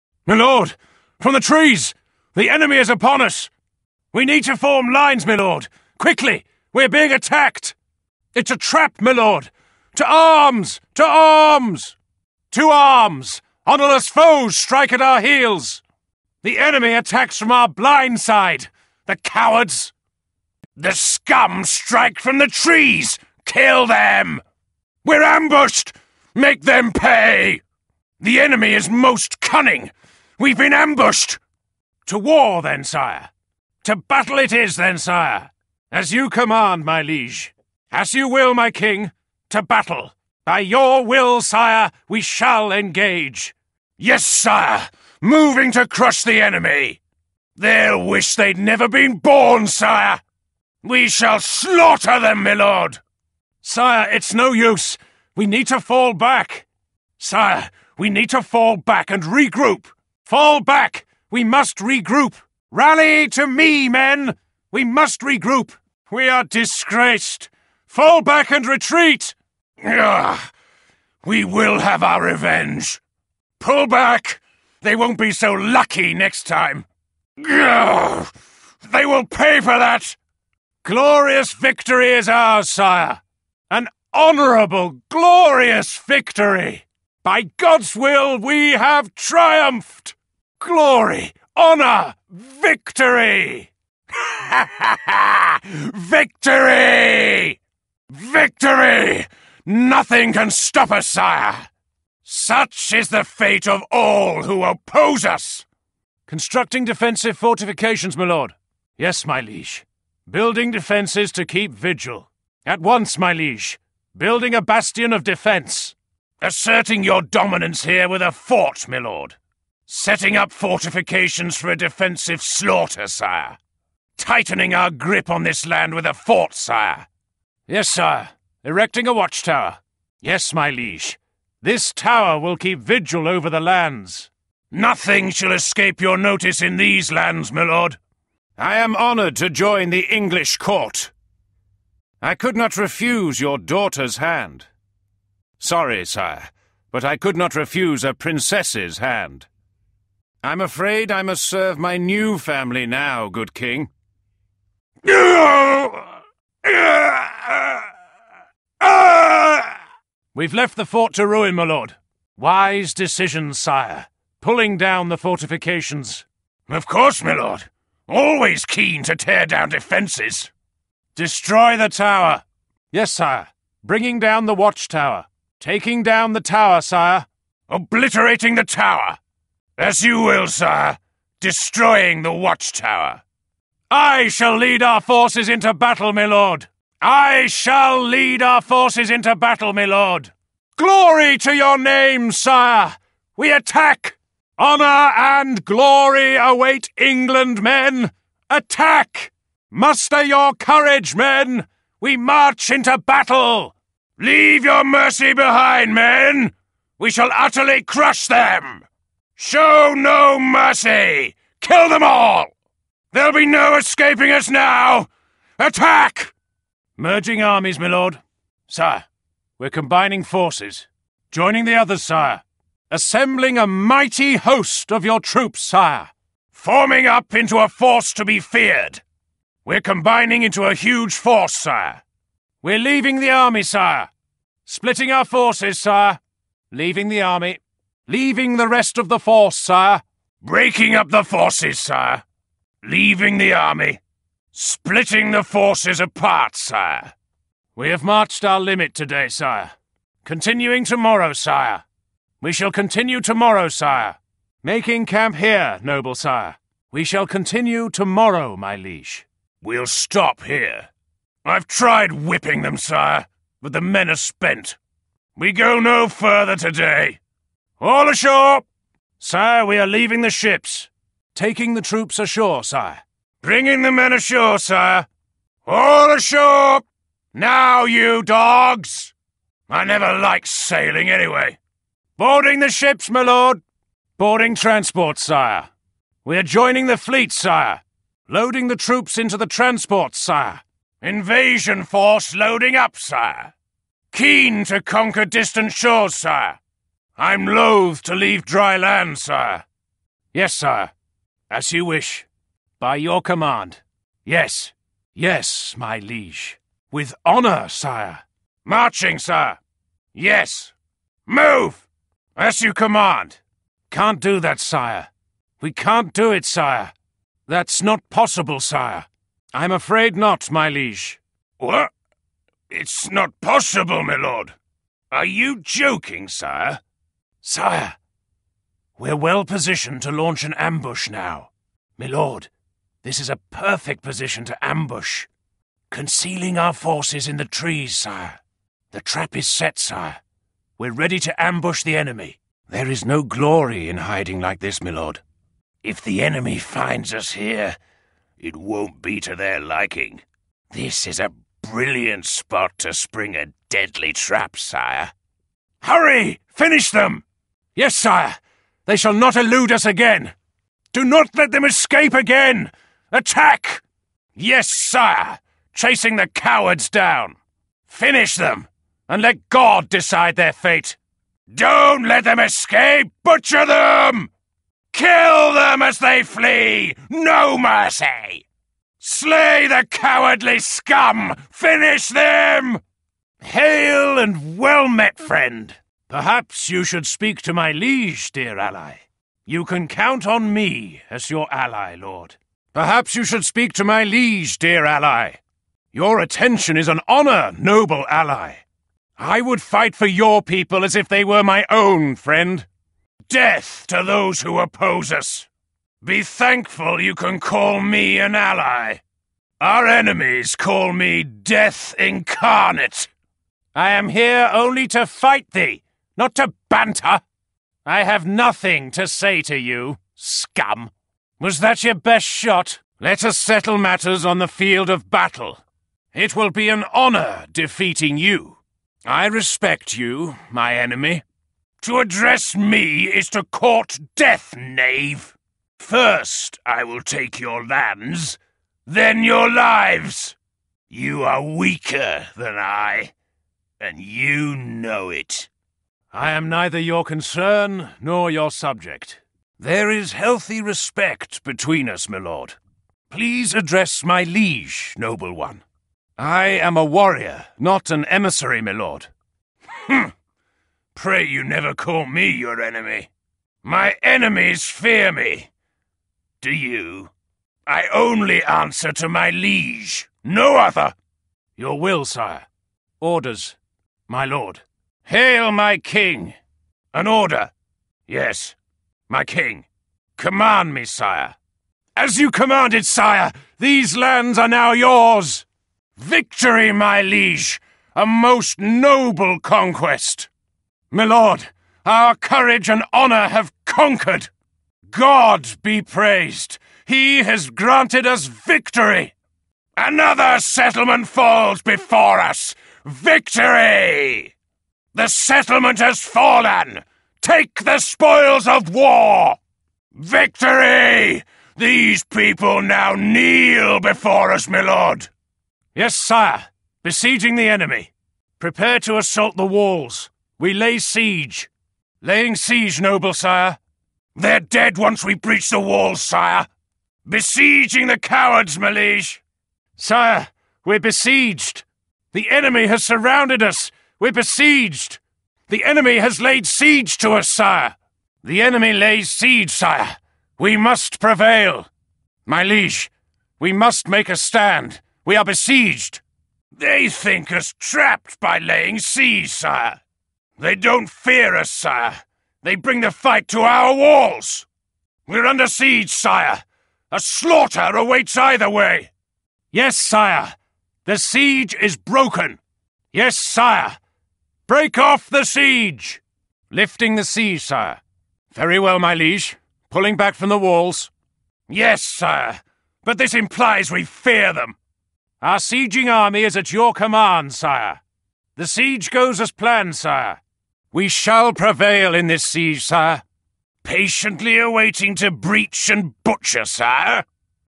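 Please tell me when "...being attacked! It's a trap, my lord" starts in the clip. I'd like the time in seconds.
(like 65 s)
6 s.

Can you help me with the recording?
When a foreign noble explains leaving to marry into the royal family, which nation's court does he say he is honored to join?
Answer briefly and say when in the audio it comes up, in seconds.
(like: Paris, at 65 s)
English, at 140 s.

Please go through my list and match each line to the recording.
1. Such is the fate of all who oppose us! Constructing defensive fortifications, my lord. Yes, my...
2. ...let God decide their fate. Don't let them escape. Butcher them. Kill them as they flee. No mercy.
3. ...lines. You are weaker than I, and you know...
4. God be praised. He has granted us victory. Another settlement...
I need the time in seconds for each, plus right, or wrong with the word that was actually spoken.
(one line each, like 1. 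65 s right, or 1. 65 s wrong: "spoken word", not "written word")
1. 102 s right
2. 369 s right
3. 439 s wrong: "lives", not "lines"
4. 494 s right.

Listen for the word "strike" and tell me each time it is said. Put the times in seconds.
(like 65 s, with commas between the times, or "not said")
14 s, 21 s.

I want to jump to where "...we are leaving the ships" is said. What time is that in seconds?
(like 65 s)
269 s.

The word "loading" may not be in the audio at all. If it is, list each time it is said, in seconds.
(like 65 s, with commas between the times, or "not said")
288 s, 292 s.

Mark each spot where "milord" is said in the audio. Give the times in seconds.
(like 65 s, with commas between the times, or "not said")
52 s, 331 s, 344 s, 490 s.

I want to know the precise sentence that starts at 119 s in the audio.
Setting up fortifications for a defensive slaughter, sire.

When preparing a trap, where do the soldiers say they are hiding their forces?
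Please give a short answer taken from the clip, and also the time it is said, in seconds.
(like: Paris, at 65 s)
In the trees, at 335 s.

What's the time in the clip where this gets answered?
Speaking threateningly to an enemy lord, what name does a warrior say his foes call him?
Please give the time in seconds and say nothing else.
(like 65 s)
409 s.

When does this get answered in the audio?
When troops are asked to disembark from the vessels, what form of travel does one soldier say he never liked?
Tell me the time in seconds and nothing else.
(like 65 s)
279 s.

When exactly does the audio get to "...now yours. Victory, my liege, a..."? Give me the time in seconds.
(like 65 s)
484 s.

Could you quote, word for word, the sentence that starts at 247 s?
We have marched our limit today, sire.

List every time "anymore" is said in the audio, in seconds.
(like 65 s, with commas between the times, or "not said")
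not said.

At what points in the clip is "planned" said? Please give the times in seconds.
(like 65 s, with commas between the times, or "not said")
579 s.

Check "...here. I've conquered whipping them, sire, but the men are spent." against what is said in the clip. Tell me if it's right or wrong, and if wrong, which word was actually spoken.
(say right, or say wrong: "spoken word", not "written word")
wrong: "tried", not "conquered".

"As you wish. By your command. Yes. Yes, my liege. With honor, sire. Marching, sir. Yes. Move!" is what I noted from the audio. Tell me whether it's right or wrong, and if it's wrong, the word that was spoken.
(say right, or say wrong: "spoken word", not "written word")
right.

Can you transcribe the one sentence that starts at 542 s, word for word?
My liege, we must make a stand!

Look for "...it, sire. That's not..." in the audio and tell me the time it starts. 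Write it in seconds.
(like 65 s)
316 s.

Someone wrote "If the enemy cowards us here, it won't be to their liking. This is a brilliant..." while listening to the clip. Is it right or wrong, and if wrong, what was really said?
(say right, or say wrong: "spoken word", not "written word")
wrong: "finds", not "cowards".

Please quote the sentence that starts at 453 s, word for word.
Please address my liege, noble one.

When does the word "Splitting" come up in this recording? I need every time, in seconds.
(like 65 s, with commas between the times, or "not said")
234 s, 244 s.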